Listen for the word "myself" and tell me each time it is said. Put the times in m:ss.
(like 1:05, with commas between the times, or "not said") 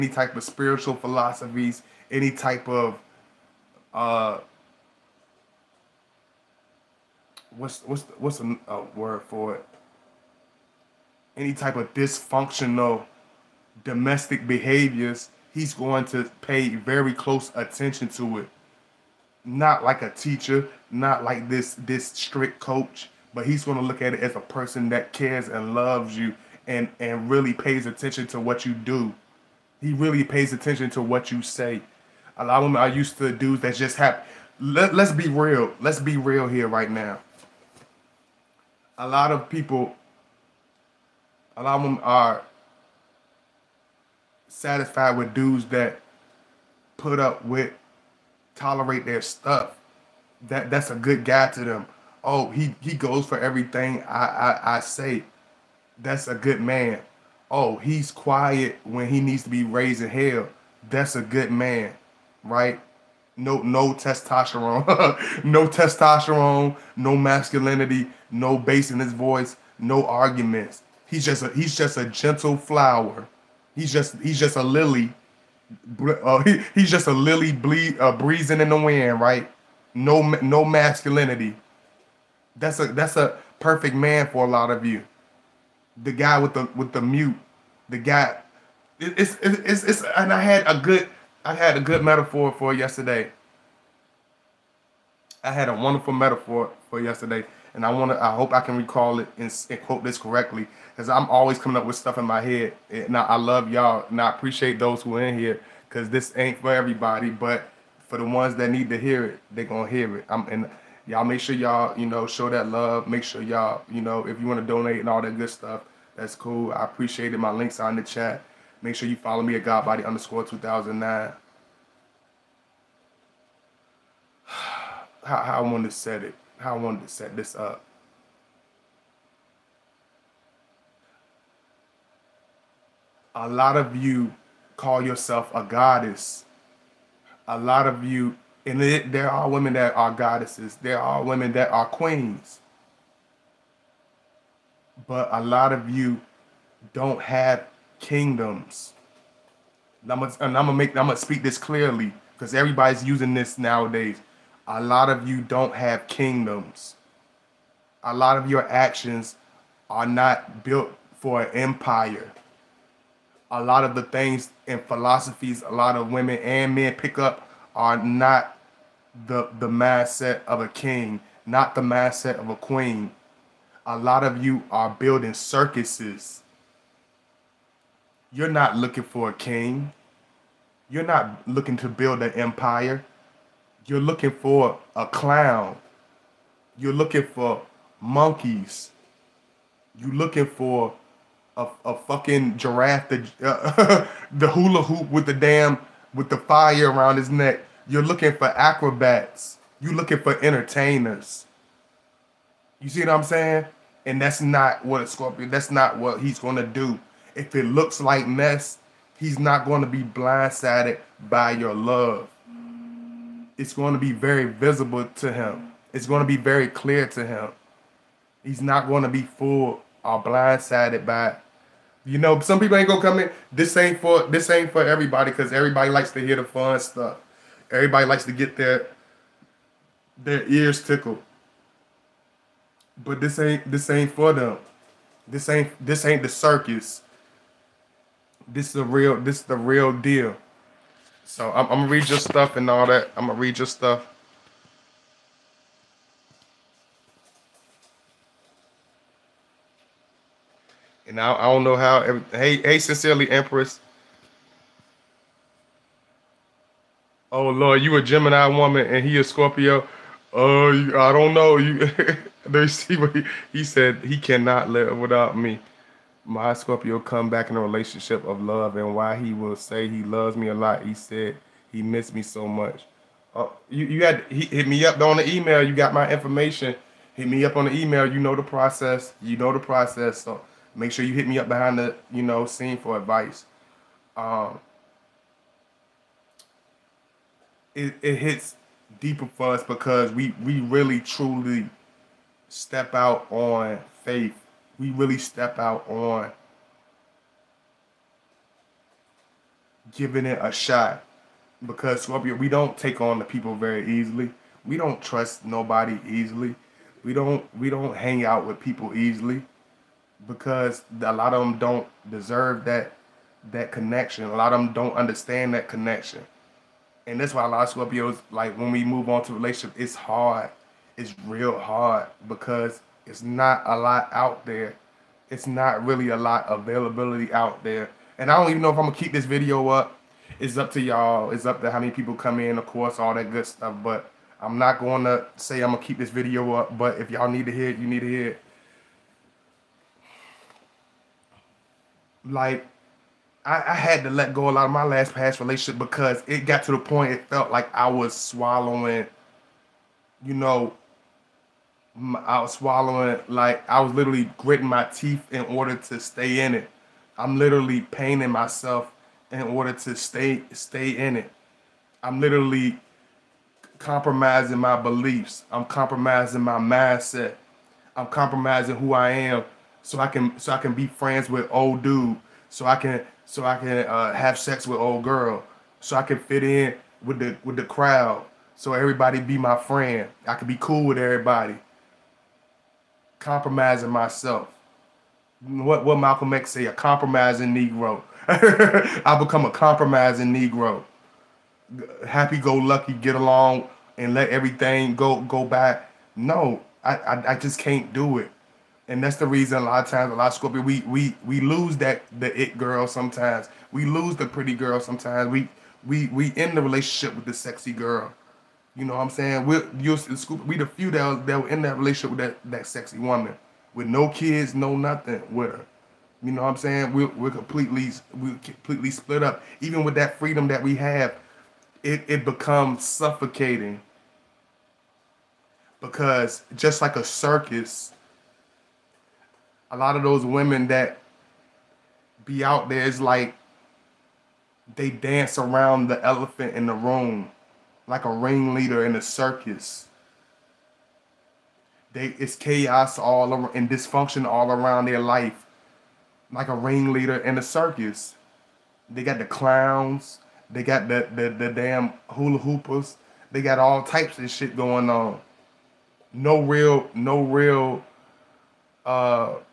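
5:58, 6:23.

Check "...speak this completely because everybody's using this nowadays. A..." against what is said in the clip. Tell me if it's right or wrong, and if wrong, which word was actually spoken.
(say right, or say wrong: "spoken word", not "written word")
wrong: "clearly", not "completely".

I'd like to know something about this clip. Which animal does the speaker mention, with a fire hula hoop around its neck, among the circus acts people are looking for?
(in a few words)
giraffe.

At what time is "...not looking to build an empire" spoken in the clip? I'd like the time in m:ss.
3:01.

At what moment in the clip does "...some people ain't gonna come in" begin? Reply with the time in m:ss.
3:42.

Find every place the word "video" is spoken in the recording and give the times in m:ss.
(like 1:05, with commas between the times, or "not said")
5:29, 5:36.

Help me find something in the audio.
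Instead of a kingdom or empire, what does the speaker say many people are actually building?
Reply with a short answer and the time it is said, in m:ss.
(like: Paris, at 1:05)
circuses, at 2:53.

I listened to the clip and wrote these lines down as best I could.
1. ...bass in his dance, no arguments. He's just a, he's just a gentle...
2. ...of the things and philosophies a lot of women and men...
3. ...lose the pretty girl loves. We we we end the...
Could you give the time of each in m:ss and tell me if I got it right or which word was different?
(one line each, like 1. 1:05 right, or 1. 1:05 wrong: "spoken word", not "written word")
1. 1:08 wrong: "voice", not "dance"
2. 2:43 right
3. 6:43 wrong: "sometimes", not "loves".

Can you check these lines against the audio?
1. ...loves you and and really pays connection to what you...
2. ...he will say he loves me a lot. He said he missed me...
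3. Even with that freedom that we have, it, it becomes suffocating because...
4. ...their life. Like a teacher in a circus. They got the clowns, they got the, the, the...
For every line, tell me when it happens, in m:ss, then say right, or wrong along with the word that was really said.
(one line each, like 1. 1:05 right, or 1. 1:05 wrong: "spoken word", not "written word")
1. 0:25 wrong: "attention", not "connection"
2. 4:29 right
3. 6:59 right
4. 7:24 wrong: "ringleader", not "teacher".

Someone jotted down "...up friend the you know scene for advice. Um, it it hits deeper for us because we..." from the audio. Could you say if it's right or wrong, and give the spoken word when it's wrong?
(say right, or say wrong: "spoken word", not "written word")
wrong: "behind", not "friend".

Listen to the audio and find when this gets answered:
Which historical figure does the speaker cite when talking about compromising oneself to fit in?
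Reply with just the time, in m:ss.
6:25.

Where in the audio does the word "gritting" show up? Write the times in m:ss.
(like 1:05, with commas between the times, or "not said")
5:54.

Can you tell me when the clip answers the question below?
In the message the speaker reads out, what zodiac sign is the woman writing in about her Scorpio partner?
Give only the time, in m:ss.
4:18.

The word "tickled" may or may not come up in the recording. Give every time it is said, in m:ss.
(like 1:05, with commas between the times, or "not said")
3:50.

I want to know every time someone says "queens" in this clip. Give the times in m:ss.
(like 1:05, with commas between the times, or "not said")
2:21, 2:52.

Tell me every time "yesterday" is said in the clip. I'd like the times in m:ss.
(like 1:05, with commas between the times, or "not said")
1:32, 1:37.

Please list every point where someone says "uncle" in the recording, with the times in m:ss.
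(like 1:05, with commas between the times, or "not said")
not said.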